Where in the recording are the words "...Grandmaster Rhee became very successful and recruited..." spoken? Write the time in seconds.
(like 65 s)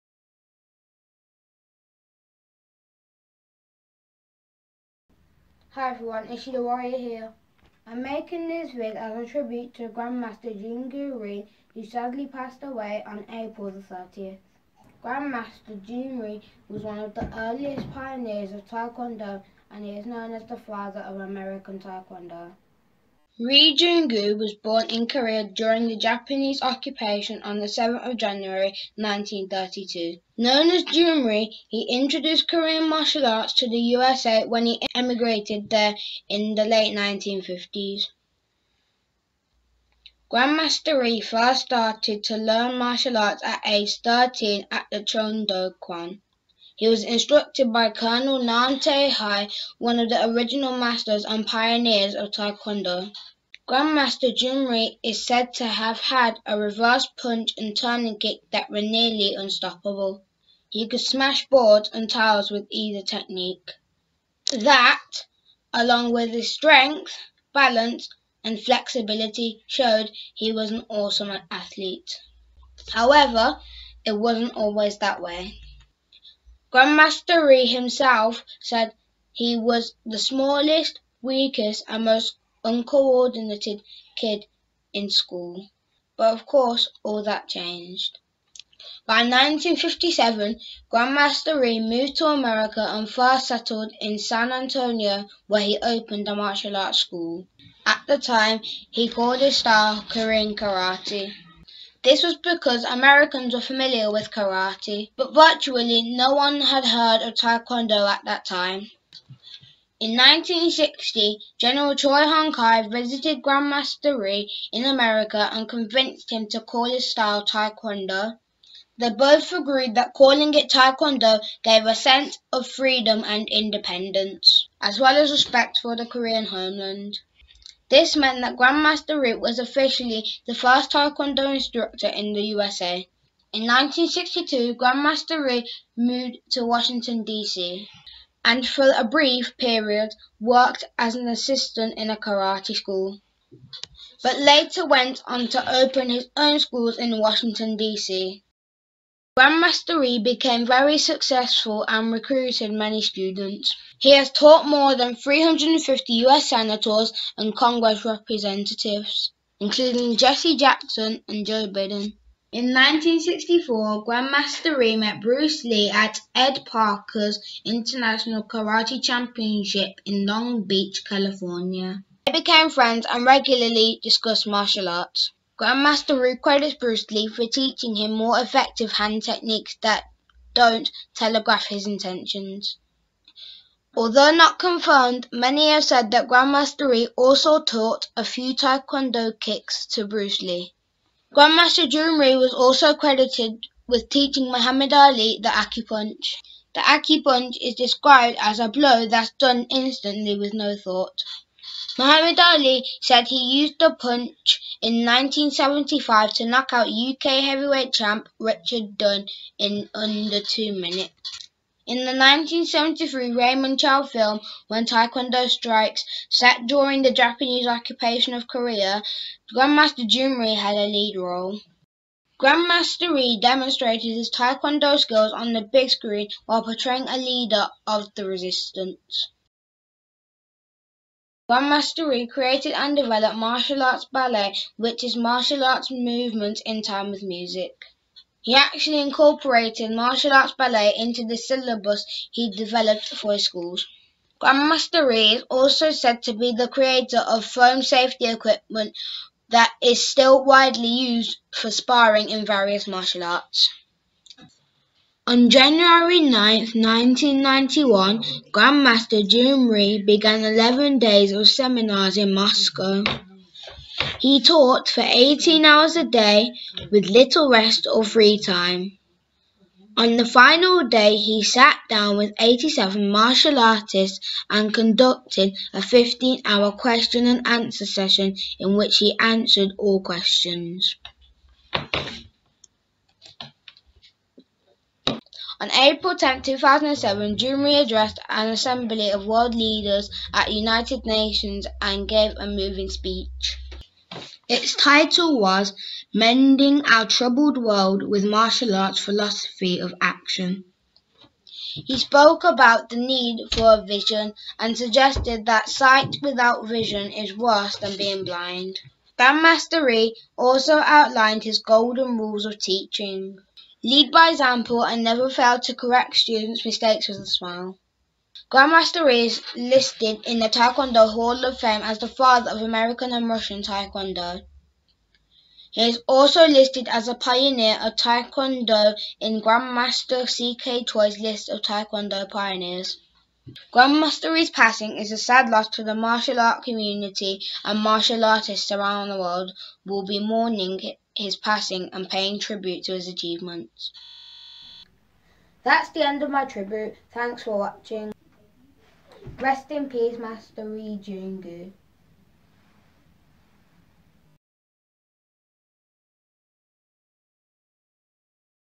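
149 s.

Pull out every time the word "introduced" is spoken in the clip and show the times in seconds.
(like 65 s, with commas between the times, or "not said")
31 s.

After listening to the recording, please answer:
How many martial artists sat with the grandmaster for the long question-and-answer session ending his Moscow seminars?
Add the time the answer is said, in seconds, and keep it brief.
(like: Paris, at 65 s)
87, at 272 s.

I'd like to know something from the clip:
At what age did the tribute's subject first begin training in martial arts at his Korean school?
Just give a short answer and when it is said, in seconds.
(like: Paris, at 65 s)
13, at 44 s.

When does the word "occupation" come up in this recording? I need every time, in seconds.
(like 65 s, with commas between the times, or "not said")
26 s, 217 s.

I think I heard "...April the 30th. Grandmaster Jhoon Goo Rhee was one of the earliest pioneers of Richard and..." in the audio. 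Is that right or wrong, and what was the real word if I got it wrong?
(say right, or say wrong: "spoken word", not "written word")
wrong: "Taekwondo", not "Richard".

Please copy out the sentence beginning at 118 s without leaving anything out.
They both agreed that calling it Taekwondo gave a sense of freedom and independence, as well as respect for the Korean homeland.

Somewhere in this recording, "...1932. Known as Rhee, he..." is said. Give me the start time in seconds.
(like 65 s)
28 s.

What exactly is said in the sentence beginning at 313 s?
Lead by example and never fail to correct students' mistakes with a smile.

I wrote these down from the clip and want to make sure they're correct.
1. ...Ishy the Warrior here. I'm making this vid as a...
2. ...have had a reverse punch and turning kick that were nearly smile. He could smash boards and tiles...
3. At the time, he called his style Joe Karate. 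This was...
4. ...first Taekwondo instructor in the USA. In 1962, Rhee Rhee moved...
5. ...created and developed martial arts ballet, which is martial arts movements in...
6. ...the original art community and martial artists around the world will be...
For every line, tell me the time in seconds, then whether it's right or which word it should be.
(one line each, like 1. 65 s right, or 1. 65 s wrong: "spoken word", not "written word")
1. 6 s right
2. 55 s wrong: "unstoppable", not "smile"
3. 97 s wrong: "Korean", not "Joe"
4. 130 s wrong: "Grandmaster", not "Rhee"
5. 232 s right
6. 335 s wrong: "martial", not "original".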